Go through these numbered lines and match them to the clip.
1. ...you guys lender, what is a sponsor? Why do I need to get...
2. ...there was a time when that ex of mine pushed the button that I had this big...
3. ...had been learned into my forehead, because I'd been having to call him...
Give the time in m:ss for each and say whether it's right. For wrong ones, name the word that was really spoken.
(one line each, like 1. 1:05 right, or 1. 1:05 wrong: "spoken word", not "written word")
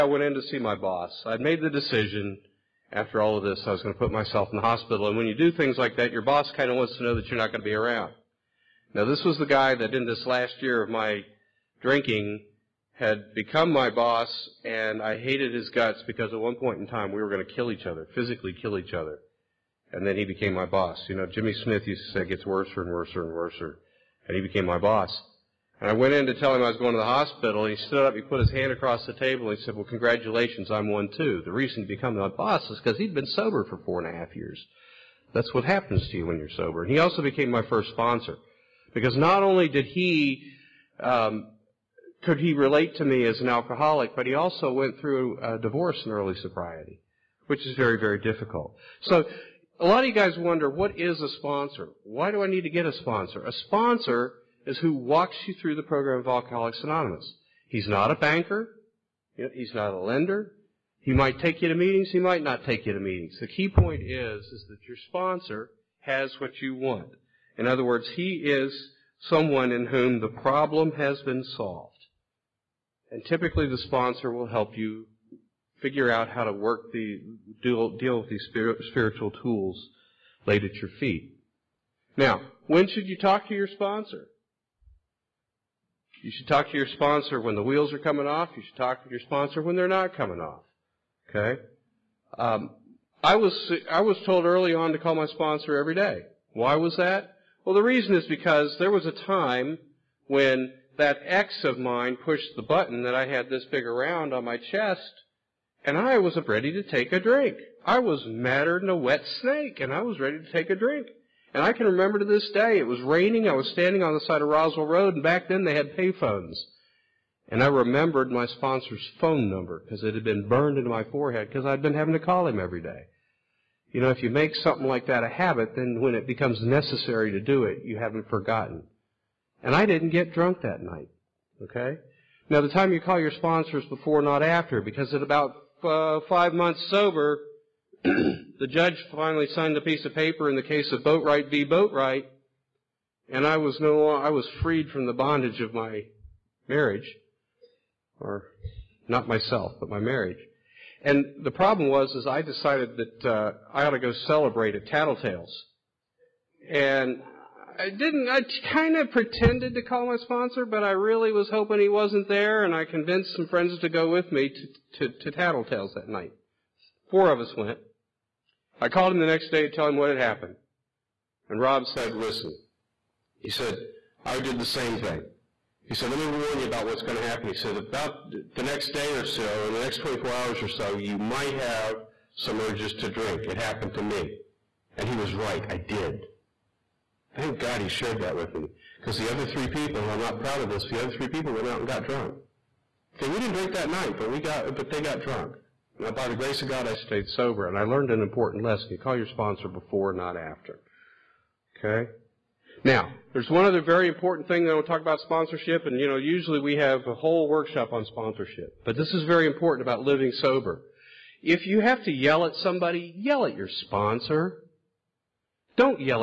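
1. 0:50 wrong: "wonder", not "lender"
2. 1:38 right
3. 2:00 wrong: "burned", not "learned".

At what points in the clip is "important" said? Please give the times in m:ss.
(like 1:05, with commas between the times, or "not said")
3:18, 3:24, 3:29.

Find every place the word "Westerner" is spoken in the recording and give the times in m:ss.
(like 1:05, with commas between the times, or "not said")
not said.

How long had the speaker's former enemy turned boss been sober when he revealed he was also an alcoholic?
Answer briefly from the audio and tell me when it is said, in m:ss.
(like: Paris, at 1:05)
4 and a half years, at 0:33.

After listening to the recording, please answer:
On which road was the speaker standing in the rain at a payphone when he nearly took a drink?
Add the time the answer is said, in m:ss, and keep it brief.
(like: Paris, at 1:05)
Roswell Road, at 1:54.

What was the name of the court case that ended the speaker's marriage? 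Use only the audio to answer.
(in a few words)
Boatwright v. Boatwright.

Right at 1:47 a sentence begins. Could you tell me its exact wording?
I was madder than a wet snake, and I was ready to take a drink.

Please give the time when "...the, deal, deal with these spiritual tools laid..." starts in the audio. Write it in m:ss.
1:16.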